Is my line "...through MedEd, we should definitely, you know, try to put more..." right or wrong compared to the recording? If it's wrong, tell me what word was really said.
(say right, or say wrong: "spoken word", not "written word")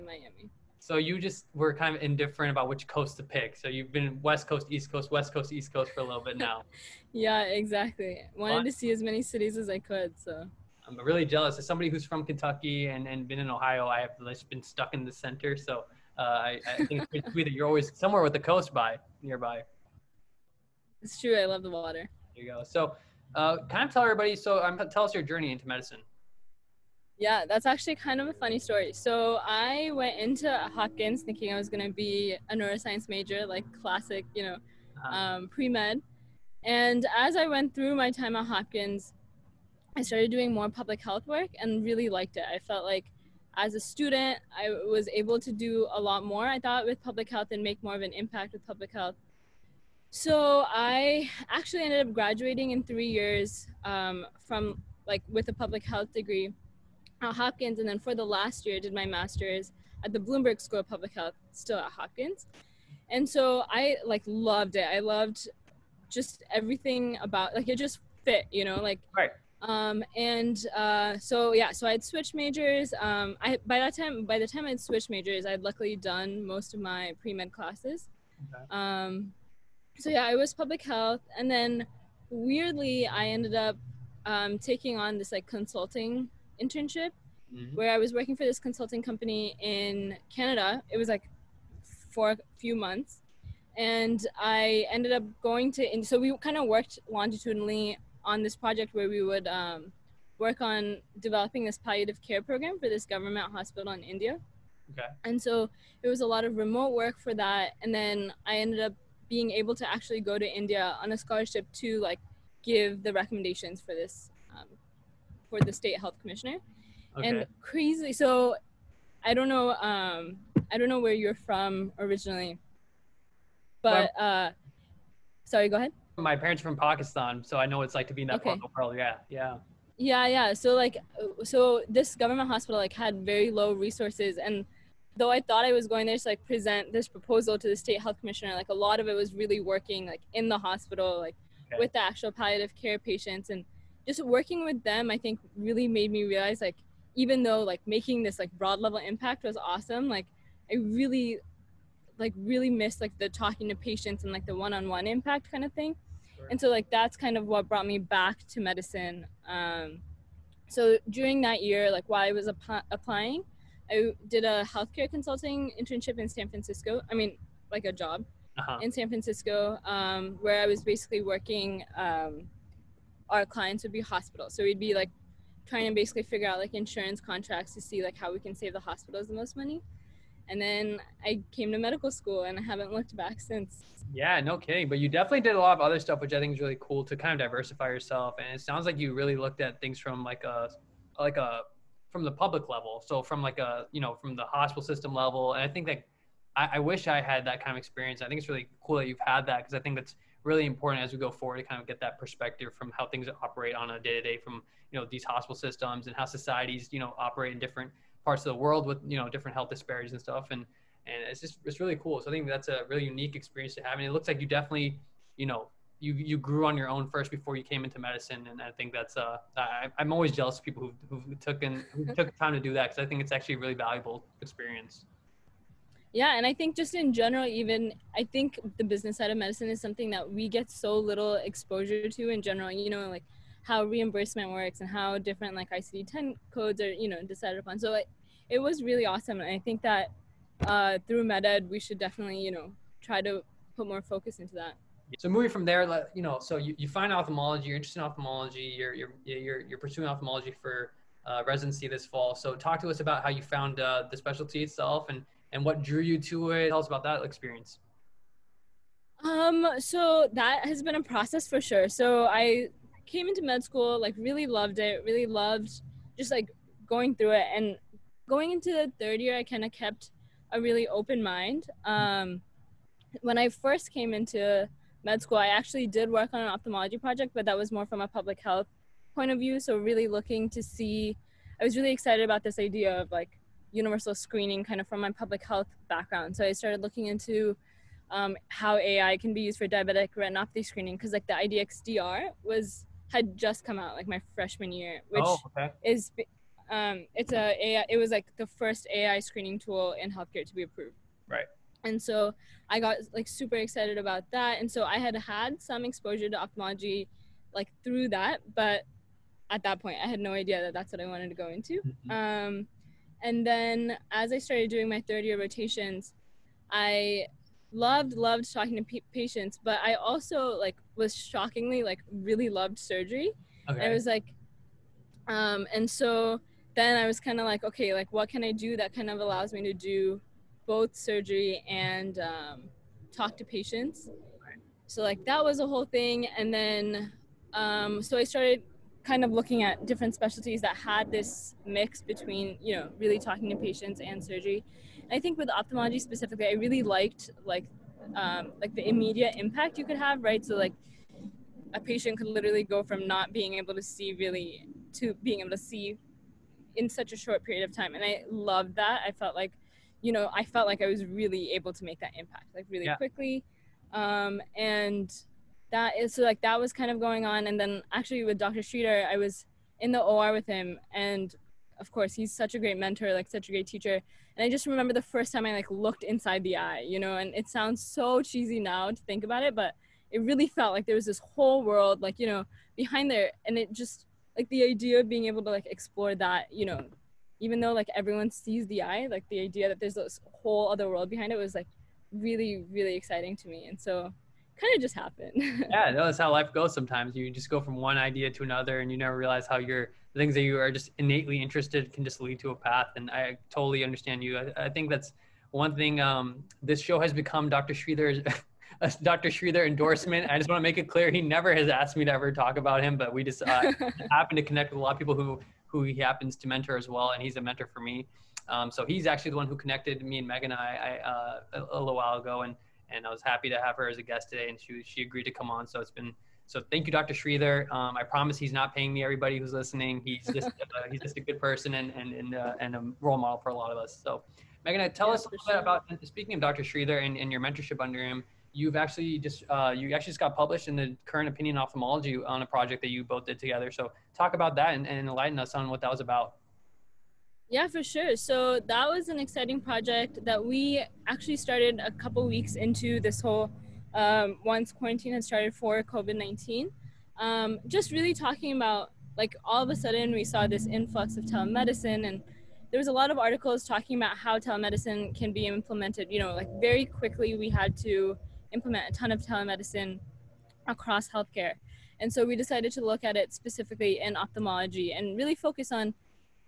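right.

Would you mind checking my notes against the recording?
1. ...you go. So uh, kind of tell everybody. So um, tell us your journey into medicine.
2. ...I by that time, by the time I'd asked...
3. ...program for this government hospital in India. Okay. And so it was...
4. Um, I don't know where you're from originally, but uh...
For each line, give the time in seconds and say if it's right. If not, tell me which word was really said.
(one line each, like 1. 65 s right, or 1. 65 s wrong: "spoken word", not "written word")
1. 22 s right
2. 73 s wrong: "switched", not "asked"
3. 102 s right
4. 119 s right.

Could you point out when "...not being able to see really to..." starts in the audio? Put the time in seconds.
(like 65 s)
353 s.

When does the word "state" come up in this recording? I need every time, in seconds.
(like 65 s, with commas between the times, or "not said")
115 s, 137 s.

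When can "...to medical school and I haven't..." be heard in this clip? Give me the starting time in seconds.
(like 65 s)
181 s.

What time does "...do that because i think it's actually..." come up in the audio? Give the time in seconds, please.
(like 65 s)
222 s.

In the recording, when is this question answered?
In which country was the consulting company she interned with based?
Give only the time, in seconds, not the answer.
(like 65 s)
90 s.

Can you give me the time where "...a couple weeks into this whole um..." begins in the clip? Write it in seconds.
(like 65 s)
451 s.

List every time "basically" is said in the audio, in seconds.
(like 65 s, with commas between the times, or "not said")
170 s, 175 s.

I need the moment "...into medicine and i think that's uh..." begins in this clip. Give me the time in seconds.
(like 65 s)
217 s.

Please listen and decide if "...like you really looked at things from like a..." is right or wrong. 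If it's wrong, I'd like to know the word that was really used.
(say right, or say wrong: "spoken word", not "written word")
right.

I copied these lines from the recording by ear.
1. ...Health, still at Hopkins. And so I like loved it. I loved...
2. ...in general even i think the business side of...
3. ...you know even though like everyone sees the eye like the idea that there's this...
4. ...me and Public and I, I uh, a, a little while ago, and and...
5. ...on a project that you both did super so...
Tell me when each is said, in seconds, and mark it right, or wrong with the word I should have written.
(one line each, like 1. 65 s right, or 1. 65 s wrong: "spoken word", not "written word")
1. 61 s right
2. 226 s right
3. 386 s right
4. 420 s wrong: "Megan", not "Public"
5. 442 s wrong: "together", not "super".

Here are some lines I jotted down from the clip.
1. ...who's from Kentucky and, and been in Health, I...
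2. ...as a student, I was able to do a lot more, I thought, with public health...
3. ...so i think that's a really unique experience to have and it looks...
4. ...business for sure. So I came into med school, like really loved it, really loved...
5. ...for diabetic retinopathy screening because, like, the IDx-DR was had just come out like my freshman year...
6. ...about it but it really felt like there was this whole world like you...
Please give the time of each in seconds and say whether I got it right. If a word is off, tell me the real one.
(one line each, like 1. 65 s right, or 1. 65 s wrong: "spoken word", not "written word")
1. 11 s wrong: "Ohio", not "Health"
2. 43 s right
3. 212 s right
4. 261 s wrong: "process", not "business"
5. 289 s right
6. 379 s right.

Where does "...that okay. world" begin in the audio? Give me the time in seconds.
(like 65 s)
128 s.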